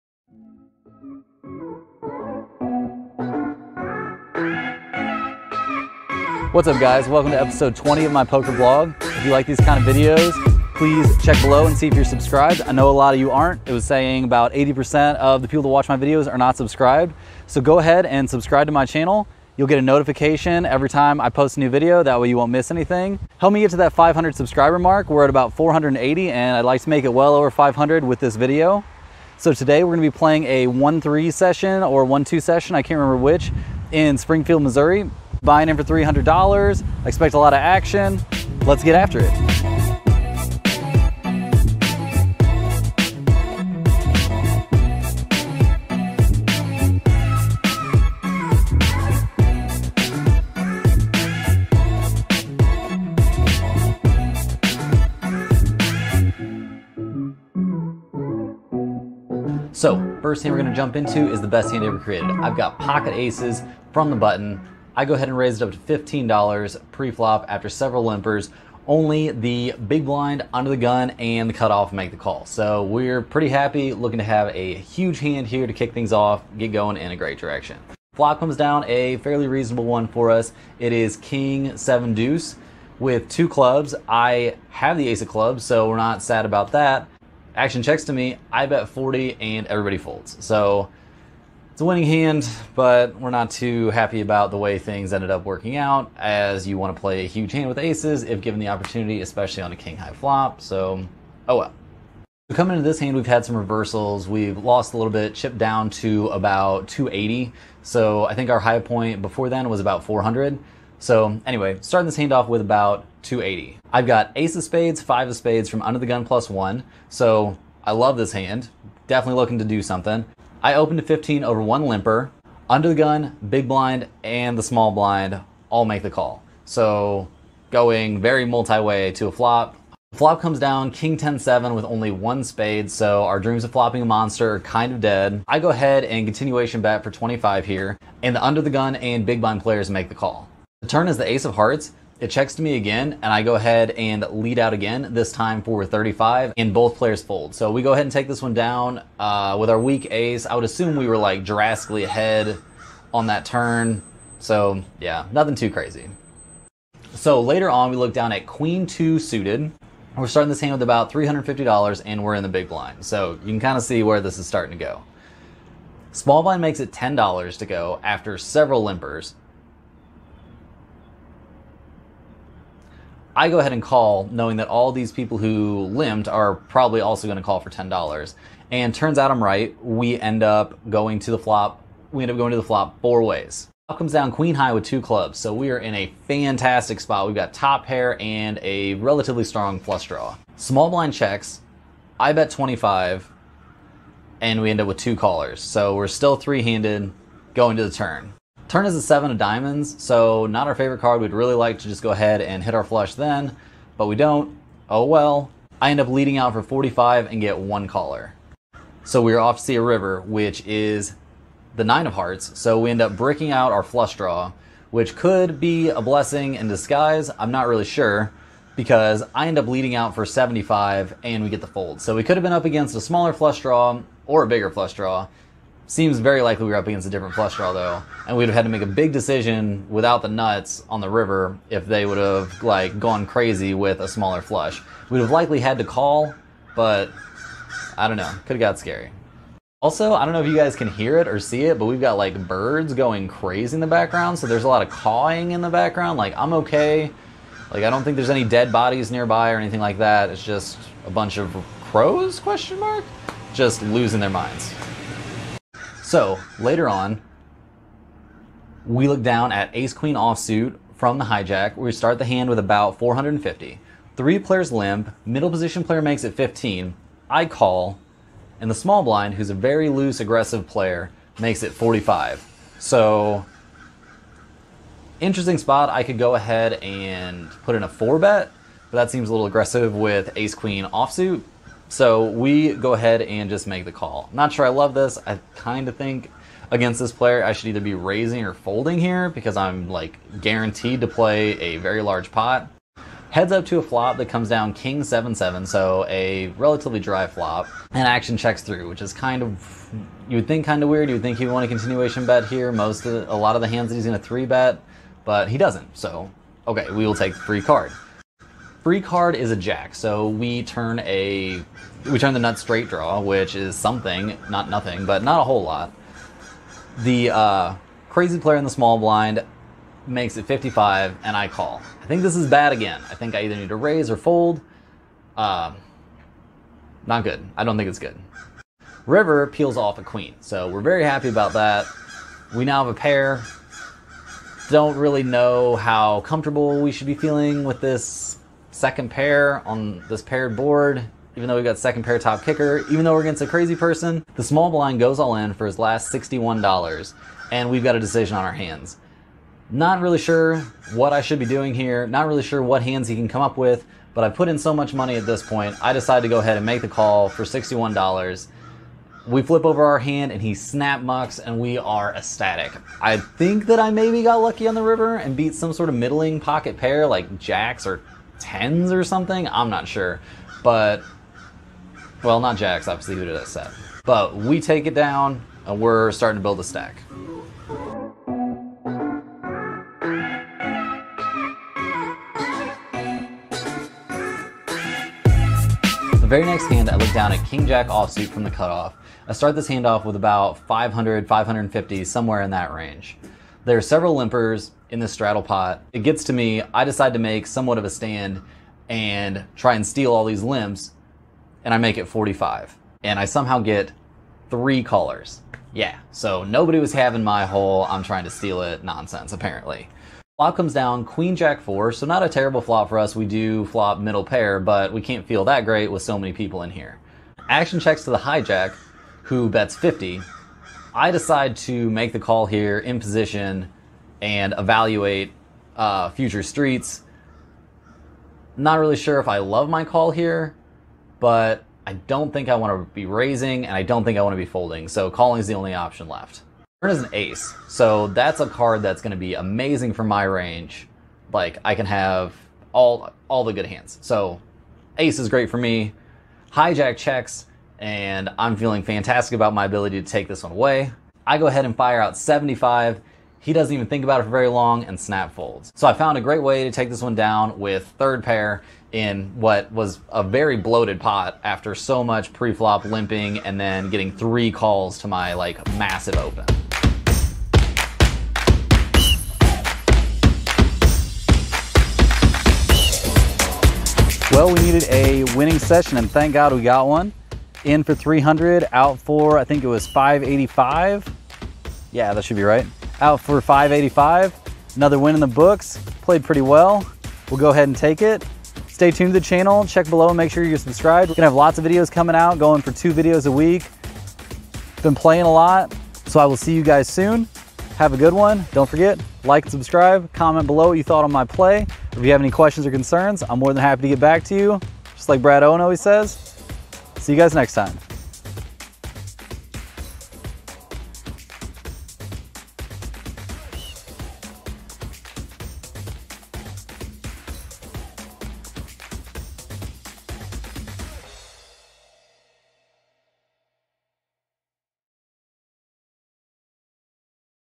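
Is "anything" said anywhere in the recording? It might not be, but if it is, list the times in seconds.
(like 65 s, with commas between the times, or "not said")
22 s, 249 s.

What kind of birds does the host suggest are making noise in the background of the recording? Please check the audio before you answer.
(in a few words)
crows.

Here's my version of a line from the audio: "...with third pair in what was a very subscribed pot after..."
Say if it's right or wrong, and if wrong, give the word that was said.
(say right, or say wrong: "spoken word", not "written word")
wrong: "bloated", not "subscribed".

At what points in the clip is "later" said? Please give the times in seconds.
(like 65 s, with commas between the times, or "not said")
157 s, 256 s.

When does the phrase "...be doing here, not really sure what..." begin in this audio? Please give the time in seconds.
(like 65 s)
351 s.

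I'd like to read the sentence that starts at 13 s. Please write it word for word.
It was saying about 80% of the people that watch my videos are not subscribed.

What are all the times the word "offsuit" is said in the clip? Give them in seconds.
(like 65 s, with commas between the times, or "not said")
260 s, 280 s, 387 s.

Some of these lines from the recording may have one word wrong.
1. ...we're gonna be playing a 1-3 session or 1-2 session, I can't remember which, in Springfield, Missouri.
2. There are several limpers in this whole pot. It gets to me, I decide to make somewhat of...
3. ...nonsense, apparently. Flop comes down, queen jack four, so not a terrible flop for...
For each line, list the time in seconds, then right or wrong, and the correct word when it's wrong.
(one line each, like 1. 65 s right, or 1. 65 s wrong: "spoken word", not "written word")
1. 29 s right
2. 393 s wrong: "straddle", not "whole"
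3. 408 s right.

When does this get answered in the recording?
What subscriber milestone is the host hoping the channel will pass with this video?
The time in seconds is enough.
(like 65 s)
23 s.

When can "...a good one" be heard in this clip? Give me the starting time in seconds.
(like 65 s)
497 s.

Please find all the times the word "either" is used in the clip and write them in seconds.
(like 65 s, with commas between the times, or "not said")
287 s, 323 s.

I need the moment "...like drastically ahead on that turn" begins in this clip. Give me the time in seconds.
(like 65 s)
151 s.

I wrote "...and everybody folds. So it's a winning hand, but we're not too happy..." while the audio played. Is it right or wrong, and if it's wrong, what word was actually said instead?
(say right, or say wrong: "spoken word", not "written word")
right.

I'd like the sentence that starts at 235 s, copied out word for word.
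We'd have likely had to call, but I don't know.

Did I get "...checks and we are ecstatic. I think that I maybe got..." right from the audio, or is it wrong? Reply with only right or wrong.
wrong.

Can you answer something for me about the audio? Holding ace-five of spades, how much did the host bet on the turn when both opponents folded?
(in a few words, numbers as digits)
35.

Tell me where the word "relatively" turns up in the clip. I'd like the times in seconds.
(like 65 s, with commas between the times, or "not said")
188 s, 296 s.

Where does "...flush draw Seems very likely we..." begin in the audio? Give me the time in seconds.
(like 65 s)
224 s.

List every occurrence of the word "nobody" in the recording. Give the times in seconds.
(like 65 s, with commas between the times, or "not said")
406 s.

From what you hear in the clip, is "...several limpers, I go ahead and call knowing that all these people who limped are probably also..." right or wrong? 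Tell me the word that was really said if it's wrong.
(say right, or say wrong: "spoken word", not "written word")
right.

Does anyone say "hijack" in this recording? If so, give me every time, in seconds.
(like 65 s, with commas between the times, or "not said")
261 s, 418 s, 446 s.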